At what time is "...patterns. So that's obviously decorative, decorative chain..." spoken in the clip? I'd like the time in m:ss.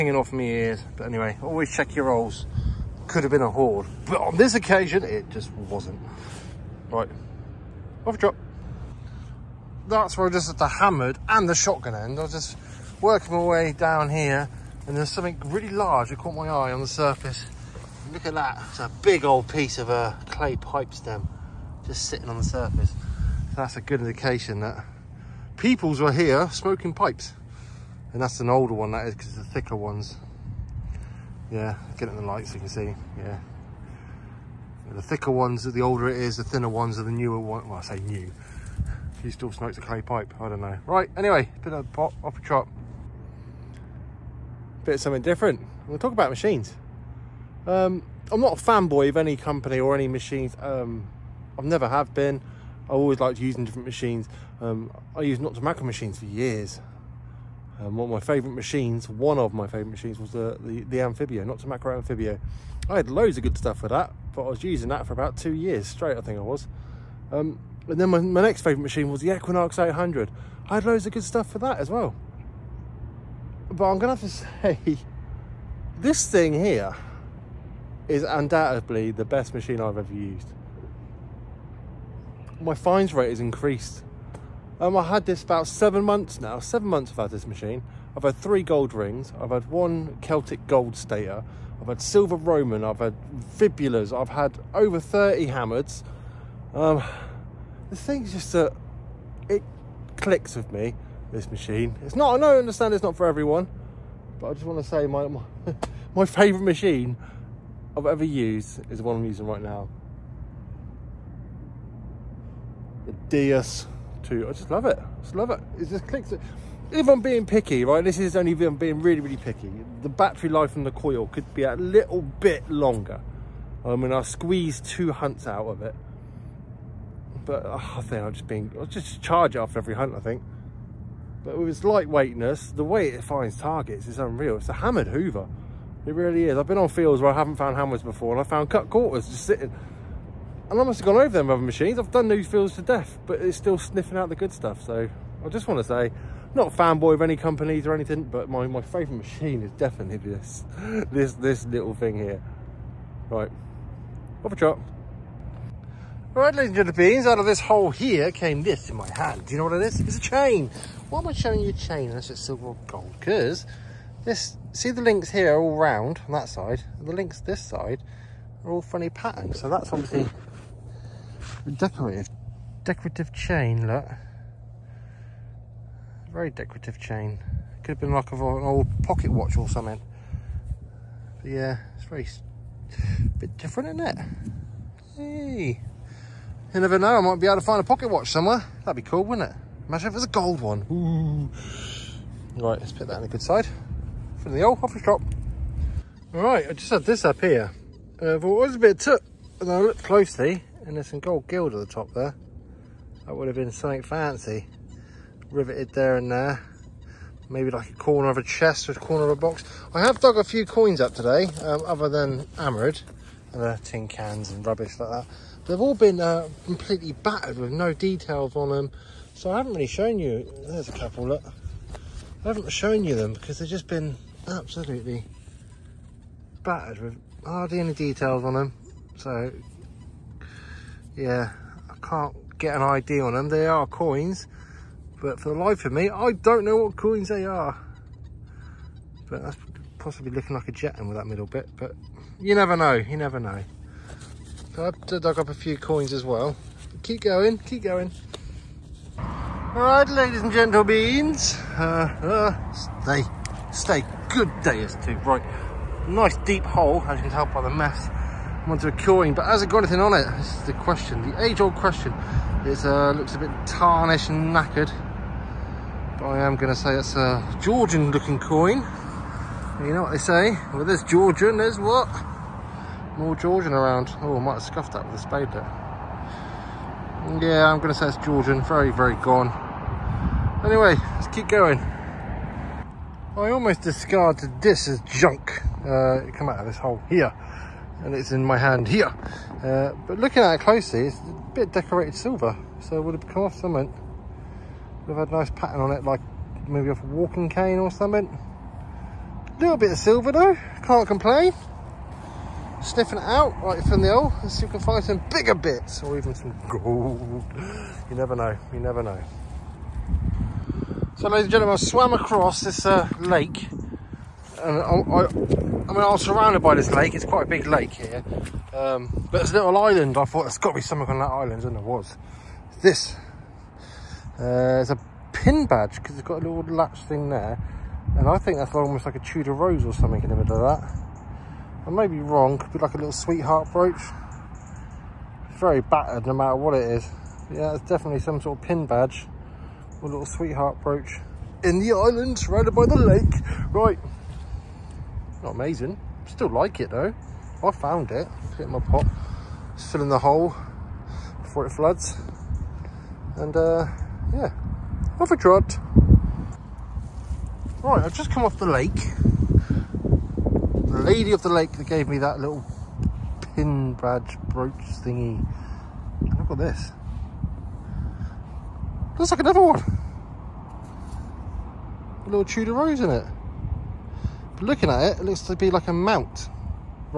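2:49.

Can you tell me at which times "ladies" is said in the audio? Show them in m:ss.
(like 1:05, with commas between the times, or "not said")
2:36, 4:10, 5:11.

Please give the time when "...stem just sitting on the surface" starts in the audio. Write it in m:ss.
0:20.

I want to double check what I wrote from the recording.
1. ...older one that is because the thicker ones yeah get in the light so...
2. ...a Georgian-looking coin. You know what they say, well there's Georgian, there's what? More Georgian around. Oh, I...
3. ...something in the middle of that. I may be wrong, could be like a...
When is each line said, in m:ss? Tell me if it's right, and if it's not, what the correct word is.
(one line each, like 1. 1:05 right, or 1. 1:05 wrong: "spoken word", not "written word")
1. 0:28 right
2. 4:27 right
3. 5:29 right.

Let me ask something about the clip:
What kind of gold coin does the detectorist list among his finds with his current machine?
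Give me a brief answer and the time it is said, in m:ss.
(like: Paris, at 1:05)
Celtic gold stater, at 1:30.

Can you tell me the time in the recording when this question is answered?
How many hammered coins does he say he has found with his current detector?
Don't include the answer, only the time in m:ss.
1:34.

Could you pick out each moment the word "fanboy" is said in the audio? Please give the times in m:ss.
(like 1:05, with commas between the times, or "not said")
0:48, 2:26.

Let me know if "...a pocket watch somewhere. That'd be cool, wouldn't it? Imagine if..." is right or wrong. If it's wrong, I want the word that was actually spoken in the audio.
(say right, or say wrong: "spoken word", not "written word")
right.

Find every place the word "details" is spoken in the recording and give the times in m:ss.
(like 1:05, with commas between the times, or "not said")
3:37, 3:47.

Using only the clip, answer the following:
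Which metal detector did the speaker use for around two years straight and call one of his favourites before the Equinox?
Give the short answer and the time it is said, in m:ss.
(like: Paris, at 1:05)
Amphibio, at 1:01.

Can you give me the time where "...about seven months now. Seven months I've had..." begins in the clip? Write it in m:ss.
1:25.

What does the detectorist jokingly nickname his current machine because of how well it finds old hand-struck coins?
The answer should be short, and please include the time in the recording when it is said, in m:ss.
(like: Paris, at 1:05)
hammered Hoover, at 2:14.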